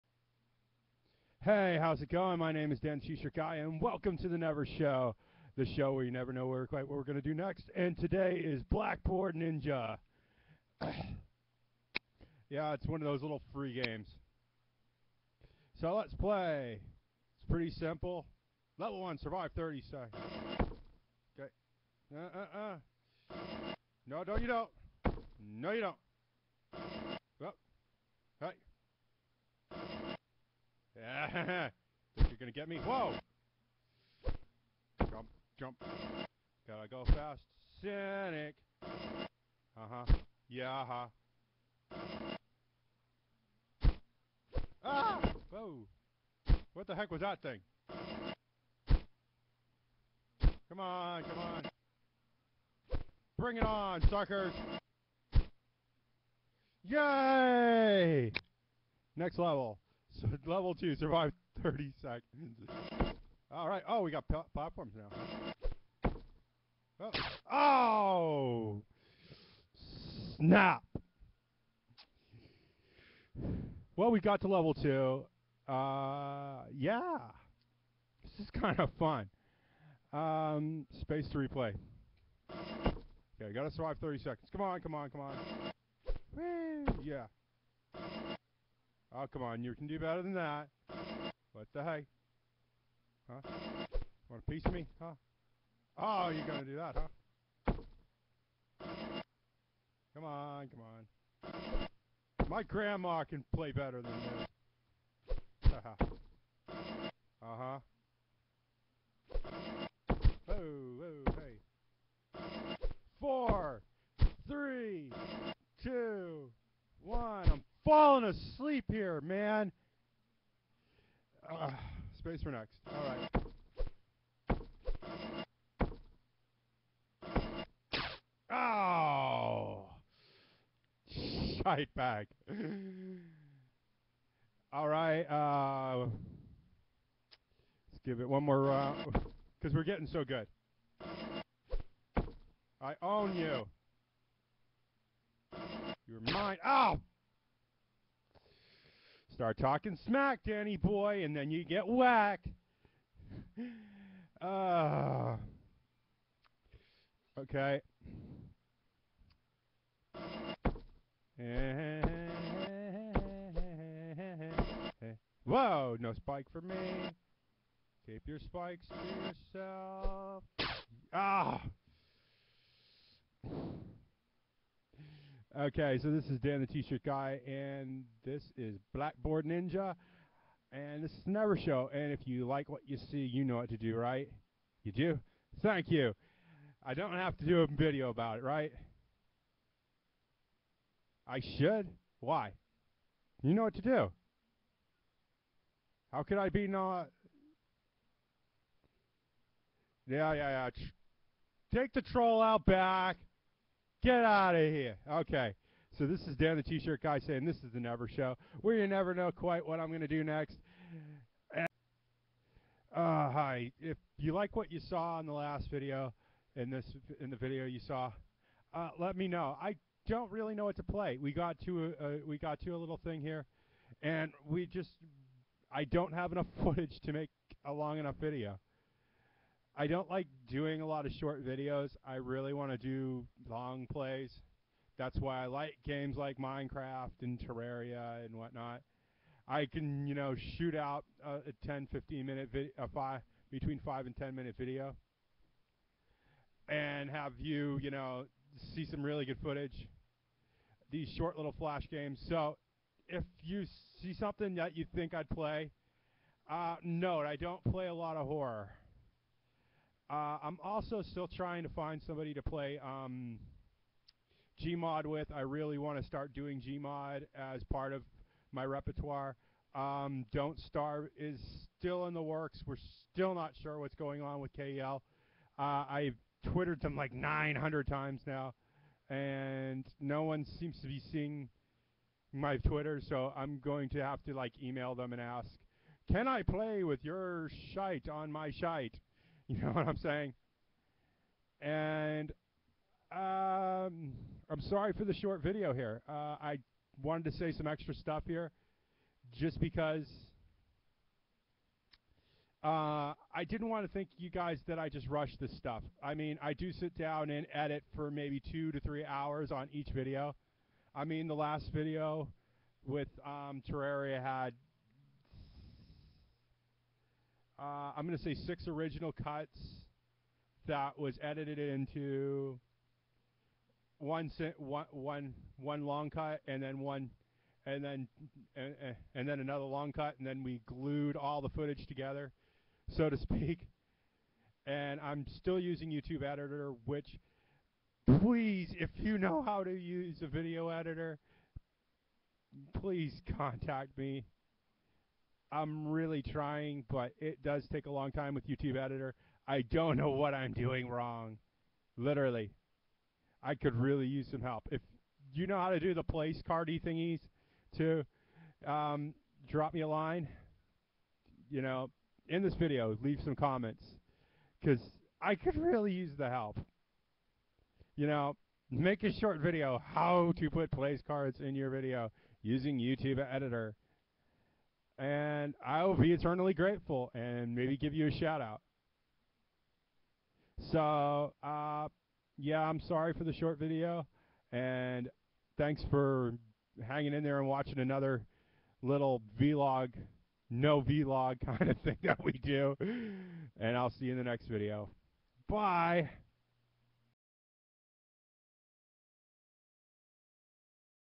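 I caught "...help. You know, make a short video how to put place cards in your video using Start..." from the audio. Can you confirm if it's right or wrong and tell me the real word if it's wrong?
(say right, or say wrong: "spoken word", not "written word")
wrong: "YouTube", not "Start".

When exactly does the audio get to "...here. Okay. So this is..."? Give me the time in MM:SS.
03:24.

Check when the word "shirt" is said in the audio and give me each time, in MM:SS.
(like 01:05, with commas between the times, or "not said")
02:56, 03:26.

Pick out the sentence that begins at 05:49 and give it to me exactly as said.
I don't know what I'm doing wrong.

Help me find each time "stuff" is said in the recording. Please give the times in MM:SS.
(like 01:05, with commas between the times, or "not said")
04:57, 05:05.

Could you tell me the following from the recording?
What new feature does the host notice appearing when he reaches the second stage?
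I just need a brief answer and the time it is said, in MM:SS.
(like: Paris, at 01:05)
Platforms, at 01:04.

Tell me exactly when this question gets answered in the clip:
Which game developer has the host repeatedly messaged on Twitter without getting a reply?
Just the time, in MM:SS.
04:34.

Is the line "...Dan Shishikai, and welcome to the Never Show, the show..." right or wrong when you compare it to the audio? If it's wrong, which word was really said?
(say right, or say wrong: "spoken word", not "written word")
right.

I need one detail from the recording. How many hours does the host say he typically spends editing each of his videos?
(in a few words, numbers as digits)
2 to 3 hours.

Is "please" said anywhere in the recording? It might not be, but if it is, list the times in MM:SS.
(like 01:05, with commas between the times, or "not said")
05:38, 05:42.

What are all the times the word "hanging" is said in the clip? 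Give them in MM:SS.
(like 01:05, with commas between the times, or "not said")
06:26.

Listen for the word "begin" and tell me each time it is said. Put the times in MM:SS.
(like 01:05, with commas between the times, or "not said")
not said.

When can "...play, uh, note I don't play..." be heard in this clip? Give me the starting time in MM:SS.
04:15.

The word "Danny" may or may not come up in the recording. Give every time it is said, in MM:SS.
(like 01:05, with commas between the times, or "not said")
02:30.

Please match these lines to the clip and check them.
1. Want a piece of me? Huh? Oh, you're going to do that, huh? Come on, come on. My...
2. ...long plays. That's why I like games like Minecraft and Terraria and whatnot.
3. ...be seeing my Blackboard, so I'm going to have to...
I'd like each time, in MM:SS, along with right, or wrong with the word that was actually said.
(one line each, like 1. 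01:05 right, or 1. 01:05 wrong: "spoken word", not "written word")
1. 01:34 right
2. 03:53 right
3. 04:40 wrong: "Twitter", not "Blackboard".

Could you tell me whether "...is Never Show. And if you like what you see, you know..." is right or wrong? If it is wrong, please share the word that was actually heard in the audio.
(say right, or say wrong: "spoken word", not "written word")
right.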